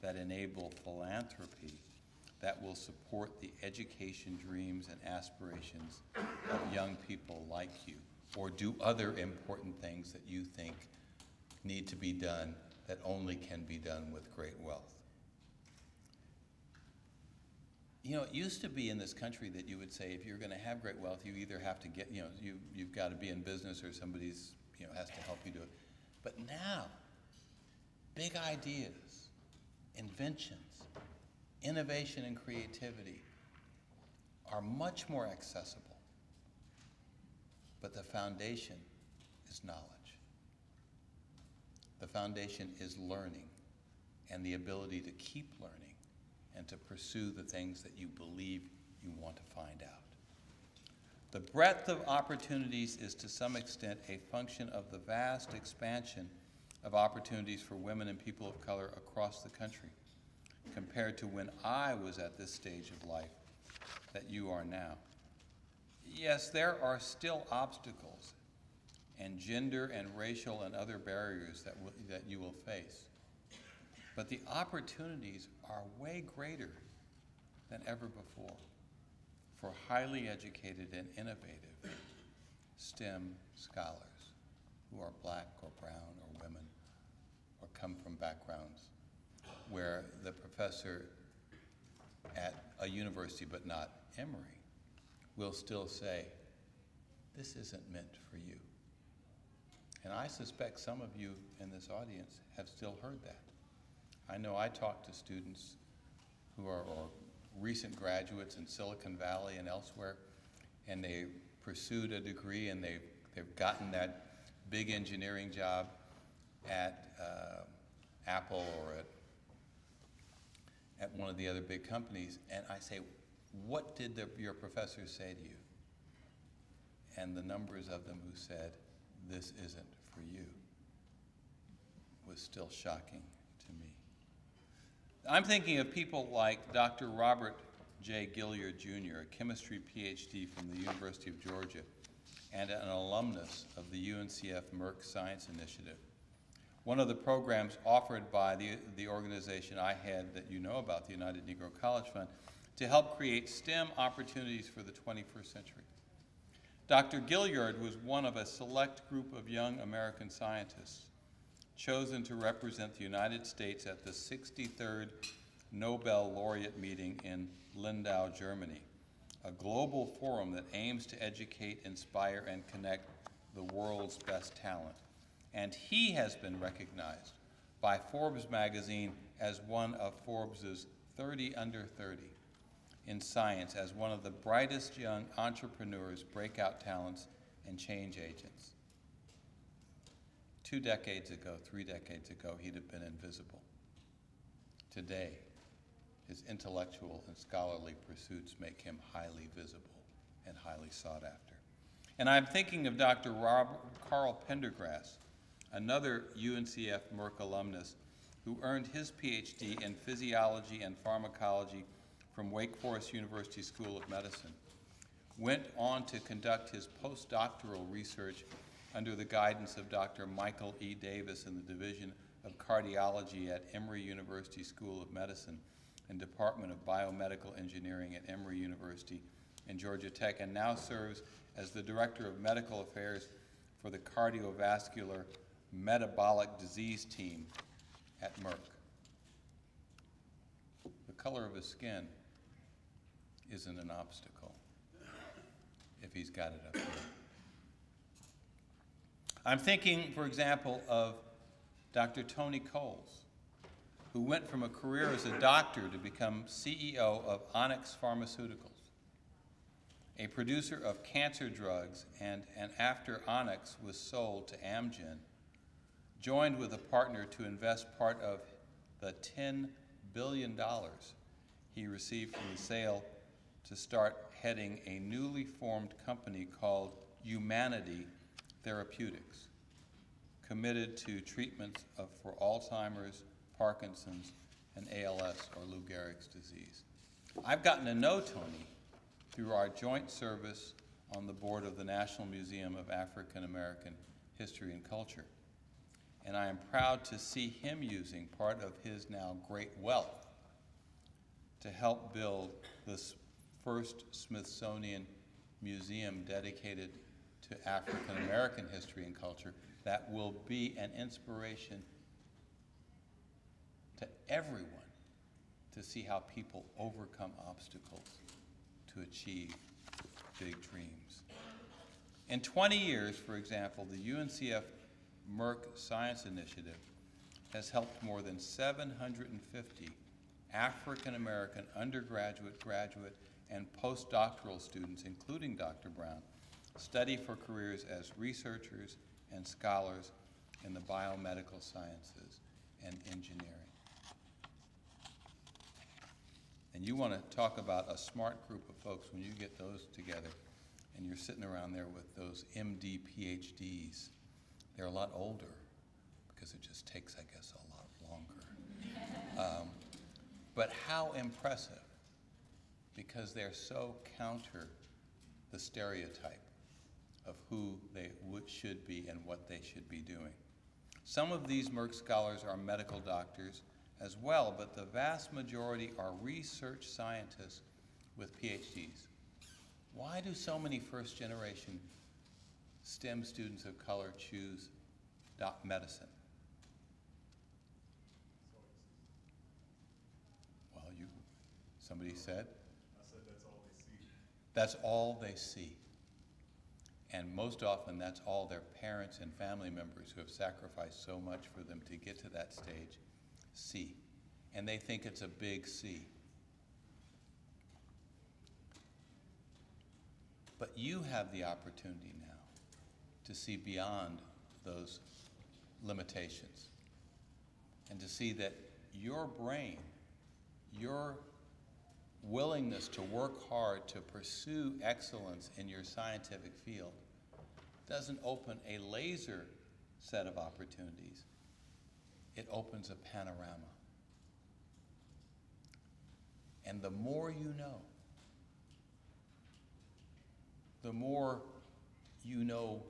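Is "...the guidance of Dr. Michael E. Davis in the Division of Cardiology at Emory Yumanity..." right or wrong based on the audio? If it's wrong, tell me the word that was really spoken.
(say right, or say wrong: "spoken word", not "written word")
wrong: "University", not "Yumanity".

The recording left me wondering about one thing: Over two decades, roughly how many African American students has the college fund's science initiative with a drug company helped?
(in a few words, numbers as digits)
750.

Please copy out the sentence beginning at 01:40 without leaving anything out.
And I suspect some of you in this audience have still heard that.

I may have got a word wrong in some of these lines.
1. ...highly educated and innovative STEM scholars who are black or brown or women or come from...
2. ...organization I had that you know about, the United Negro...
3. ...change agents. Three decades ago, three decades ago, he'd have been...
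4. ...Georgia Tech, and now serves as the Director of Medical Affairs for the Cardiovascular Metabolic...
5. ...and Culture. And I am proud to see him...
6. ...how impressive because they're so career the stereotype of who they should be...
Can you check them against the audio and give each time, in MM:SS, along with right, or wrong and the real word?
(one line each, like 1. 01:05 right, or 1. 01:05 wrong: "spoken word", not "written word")
1. 01:19 right
2. 02:29 right
3. 03:07 wrong: "Two", not "Three"
4. 03:49 right
5. 04:54 right
6. 06:00 wrong: "counter", not "career".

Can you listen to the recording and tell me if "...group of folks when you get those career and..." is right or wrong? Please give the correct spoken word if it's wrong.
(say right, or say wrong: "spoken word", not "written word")
wrong: "together", not "career".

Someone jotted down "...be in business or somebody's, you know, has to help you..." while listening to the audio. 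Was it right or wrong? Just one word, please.
right.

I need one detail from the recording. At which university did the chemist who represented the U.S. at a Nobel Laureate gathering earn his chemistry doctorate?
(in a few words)
University of Georgia.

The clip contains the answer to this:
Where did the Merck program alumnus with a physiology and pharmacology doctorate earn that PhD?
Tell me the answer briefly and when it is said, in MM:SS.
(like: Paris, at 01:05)
Wake Forest University School of Medicine, at 03:32.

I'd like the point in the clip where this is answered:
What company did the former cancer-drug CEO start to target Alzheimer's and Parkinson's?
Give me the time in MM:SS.
04:37.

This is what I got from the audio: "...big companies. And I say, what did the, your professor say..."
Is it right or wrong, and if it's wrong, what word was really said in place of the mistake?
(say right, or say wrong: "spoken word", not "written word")
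right.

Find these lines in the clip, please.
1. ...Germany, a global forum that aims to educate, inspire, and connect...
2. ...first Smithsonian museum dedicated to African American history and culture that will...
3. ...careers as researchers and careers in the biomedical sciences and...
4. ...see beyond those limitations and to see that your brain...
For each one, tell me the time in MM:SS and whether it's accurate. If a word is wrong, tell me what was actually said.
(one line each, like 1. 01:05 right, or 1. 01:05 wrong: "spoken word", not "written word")
1. 02:48 right
2. 05:03 right
3. 05:37 wrong: "scholars", not "careers"
4. 06:53 right.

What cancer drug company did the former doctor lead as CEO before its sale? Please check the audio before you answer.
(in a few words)
Onyx Pharmaceuticals.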